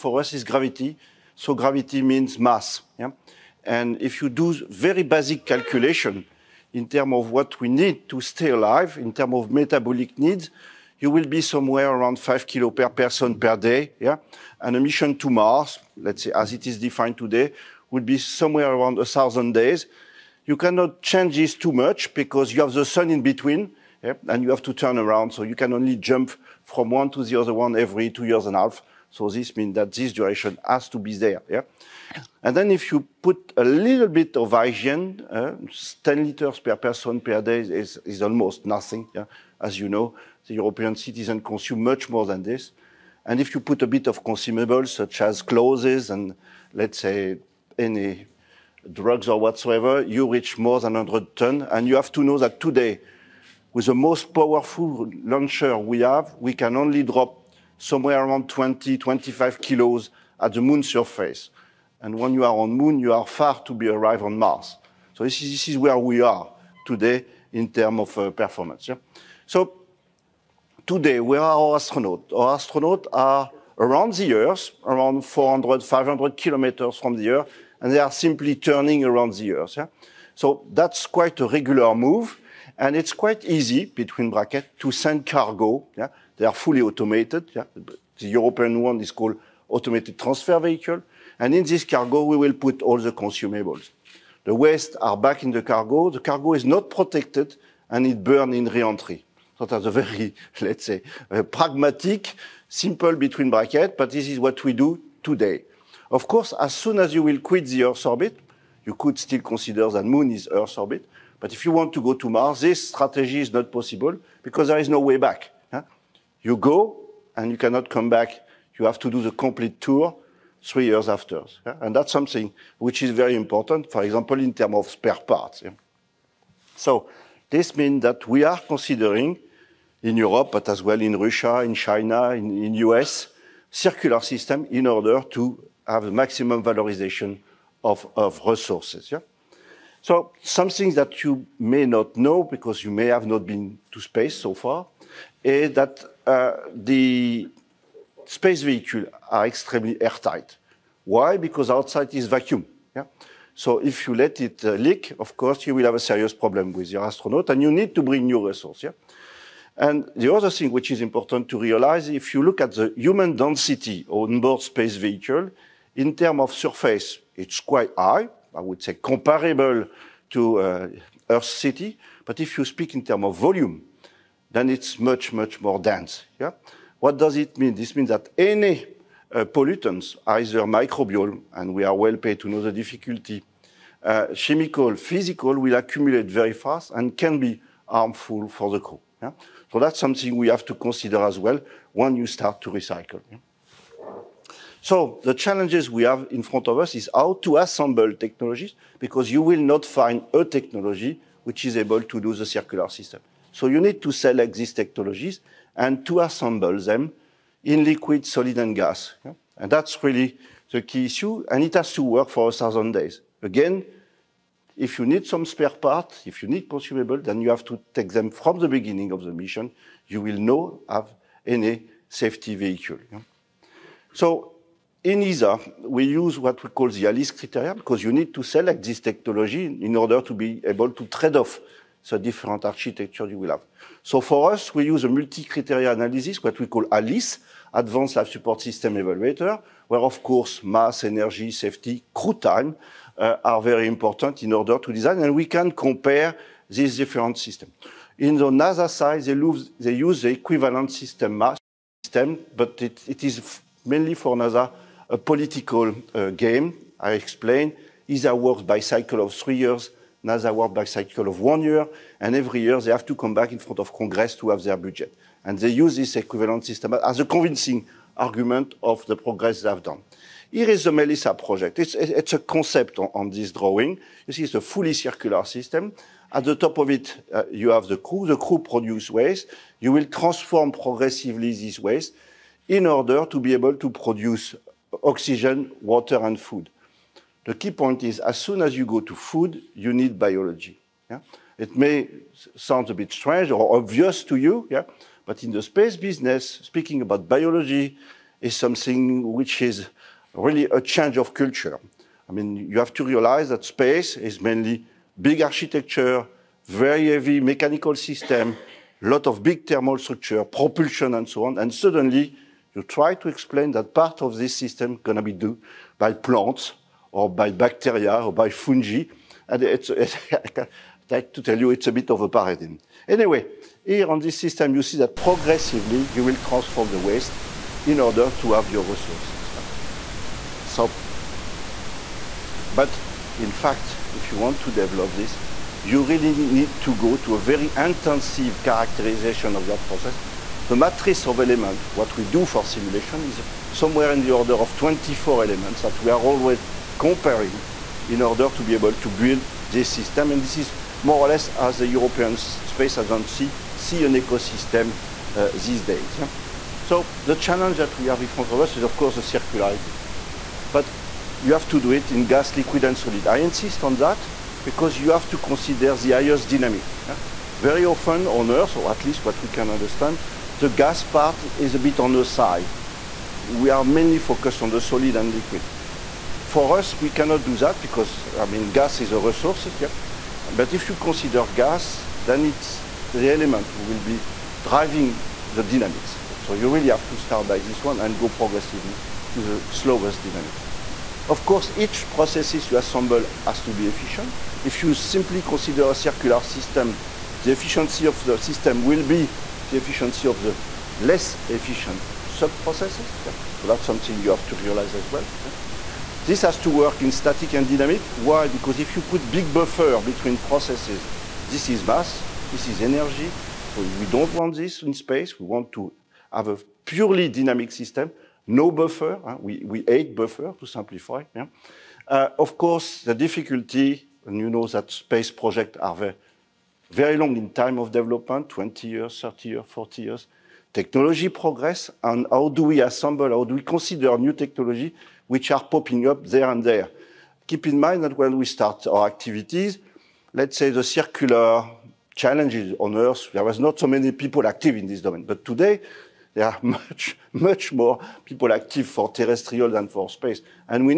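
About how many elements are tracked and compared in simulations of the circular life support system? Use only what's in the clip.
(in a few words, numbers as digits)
24.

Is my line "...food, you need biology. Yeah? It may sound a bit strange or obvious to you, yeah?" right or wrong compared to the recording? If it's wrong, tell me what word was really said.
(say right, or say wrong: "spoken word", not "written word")
right.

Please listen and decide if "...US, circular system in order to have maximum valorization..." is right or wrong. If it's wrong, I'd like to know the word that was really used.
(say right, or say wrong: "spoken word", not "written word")
right.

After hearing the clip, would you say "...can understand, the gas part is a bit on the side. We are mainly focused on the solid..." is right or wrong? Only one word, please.
right.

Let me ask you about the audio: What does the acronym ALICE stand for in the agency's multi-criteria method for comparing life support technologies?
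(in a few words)
Advanced Life Support System Evaluator.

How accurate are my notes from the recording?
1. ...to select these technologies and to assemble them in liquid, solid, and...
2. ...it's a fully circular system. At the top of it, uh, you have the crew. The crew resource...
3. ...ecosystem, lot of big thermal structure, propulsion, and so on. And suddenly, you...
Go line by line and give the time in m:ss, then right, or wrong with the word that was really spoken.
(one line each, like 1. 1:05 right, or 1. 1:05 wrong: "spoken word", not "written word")
1. 3:24 right
2. 4:34 wrong: "produce", not "resource"
3. 5:07 wrong: "system", not "ecosystem".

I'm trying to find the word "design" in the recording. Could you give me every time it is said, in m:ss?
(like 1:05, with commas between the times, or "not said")
4:04.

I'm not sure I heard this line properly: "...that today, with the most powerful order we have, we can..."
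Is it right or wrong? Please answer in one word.
wrong.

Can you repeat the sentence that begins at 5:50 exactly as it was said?
And this is more or less as the European Space Agency see an ecosystem uh, these days.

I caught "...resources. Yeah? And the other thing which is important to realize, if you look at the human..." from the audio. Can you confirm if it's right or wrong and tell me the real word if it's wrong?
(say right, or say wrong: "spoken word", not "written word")
right.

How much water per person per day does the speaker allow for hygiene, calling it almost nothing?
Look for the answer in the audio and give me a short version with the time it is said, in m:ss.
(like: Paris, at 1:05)
10 liters, at 0:36.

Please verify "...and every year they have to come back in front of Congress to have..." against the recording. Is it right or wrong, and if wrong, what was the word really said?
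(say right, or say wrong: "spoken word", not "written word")
right.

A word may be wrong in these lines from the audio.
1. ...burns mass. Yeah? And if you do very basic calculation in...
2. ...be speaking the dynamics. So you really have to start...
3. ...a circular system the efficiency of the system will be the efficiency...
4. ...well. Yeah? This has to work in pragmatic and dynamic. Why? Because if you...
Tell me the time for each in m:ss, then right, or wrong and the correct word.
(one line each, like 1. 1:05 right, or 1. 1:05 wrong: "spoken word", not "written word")
1. 0:01 wrong: "means", not "burns"
2. 6:23 wrong: "driving", not "speaking"
3. 6:35 right
4. 6:45 wrong: "static", not "pragmatic".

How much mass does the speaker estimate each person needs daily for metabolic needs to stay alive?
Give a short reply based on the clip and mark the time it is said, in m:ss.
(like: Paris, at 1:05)
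5 kilos, at 0:12.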